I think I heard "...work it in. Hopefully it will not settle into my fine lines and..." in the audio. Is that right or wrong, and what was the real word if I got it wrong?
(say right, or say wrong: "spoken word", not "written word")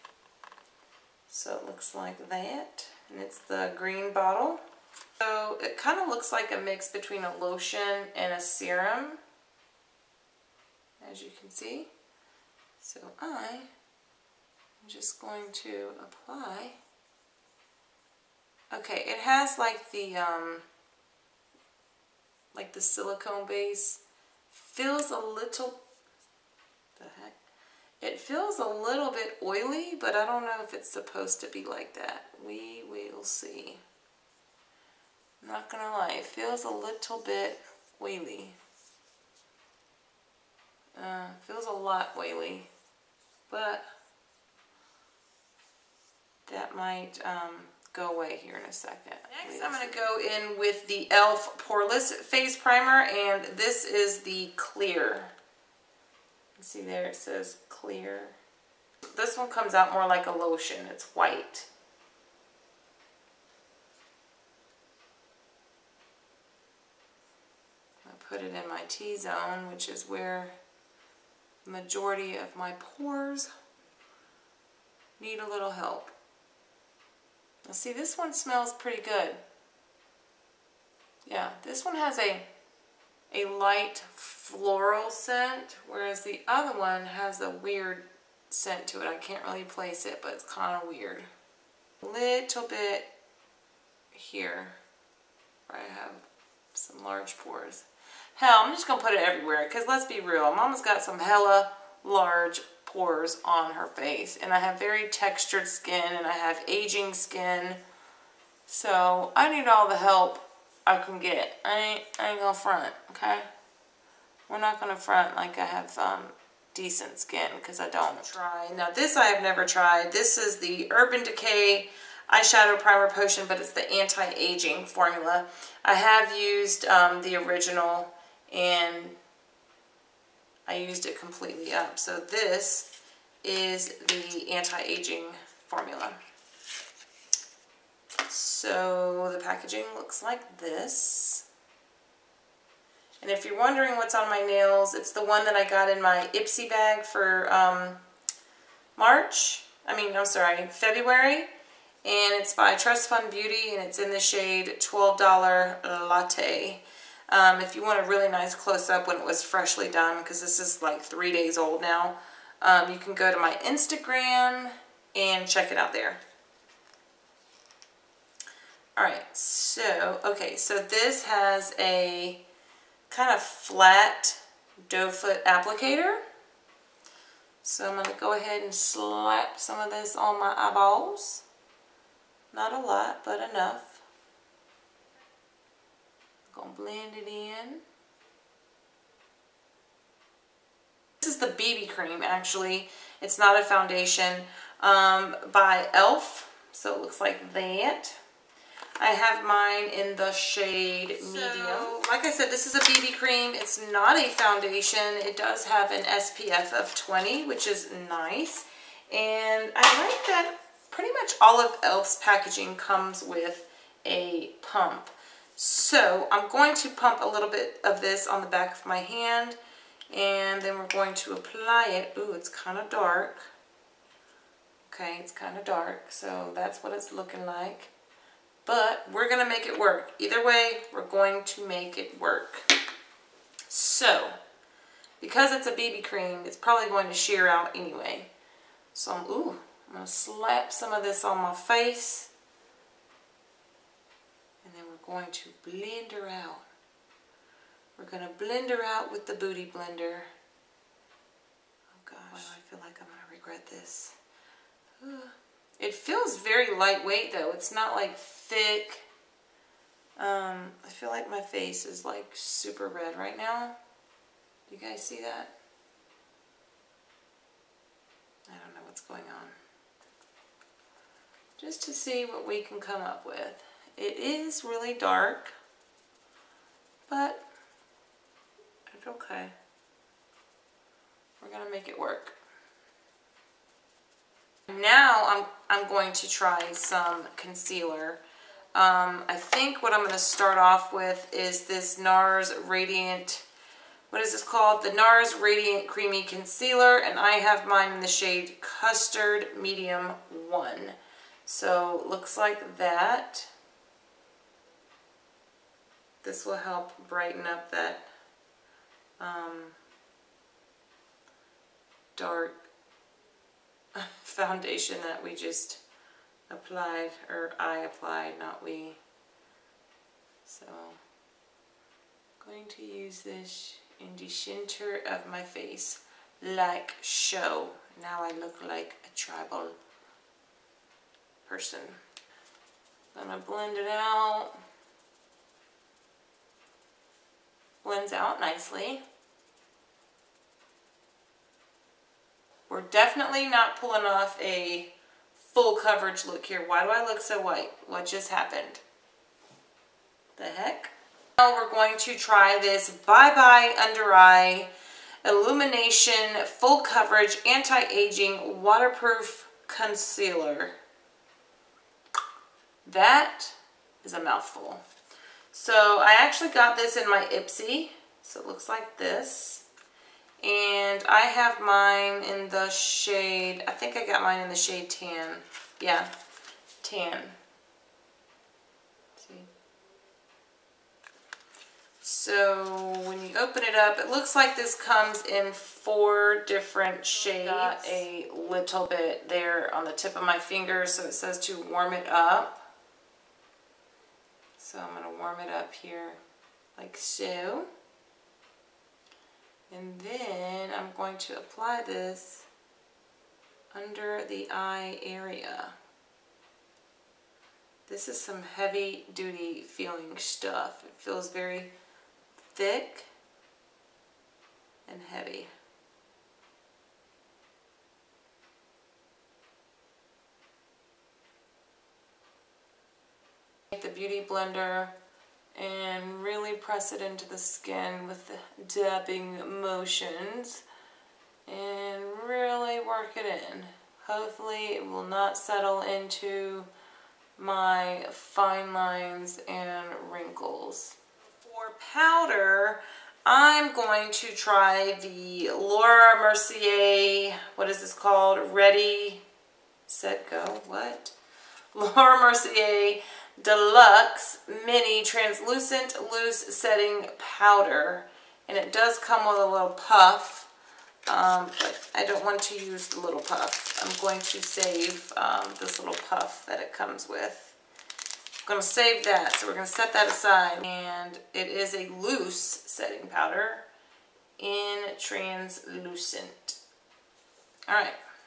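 right.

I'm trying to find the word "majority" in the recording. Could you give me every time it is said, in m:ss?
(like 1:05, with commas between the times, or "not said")
1:11.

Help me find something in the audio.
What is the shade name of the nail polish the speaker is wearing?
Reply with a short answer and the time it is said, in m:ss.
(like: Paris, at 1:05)
$12 Latte, at 2:34.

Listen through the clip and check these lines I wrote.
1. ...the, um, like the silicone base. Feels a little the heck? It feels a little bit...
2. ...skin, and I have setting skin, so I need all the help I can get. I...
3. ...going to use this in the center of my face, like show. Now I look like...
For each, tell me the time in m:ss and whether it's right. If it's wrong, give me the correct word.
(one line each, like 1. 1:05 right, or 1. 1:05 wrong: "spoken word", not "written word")
1. 0:19 right
2. 1:45 wrong: "aging", not "setting"
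3. 5:22 right.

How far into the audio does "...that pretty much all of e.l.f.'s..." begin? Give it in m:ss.
3:30.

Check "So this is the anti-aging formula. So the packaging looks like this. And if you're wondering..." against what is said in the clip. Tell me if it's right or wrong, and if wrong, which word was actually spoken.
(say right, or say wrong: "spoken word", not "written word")
right.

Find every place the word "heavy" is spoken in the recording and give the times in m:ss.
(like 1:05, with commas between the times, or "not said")
6:48, 6:55.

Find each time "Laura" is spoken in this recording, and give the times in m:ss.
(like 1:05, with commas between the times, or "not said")
7:25, 7:31.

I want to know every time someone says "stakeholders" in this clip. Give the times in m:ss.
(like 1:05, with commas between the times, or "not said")
not said.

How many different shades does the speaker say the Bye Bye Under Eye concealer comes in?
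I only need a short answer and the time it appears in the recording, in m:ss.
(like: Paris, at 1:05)
4, at 6:25.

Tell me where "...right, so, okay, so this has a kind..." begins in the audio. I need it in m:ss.
2:49.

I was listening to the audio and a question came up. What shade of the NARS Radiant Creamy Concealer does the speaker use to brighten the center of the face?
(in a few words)
Custard Medium 1.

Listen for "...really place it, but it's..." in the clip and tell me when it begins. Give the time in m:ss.
1:29.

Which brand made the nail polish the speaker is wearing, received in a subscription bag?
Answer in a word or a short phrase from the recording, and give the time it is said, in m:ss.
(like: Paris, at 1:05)
Trust Fund Beauty, at 2:32.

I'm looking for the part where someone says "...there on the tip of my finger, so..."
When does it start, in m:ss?
6:29.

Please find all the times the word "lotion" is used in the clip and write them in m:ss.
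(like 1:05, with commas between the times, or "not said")
0:07, 1:00.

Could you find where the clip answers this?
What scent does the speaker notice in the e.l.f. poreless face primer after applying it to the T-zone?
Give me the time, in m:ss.
1:23.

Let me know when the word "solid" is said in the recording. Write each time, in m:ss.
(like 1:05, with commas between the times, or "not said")
not said.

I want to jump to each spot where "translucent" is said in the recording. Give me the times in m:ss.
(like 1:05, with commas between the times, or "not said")
7:35, 7:54.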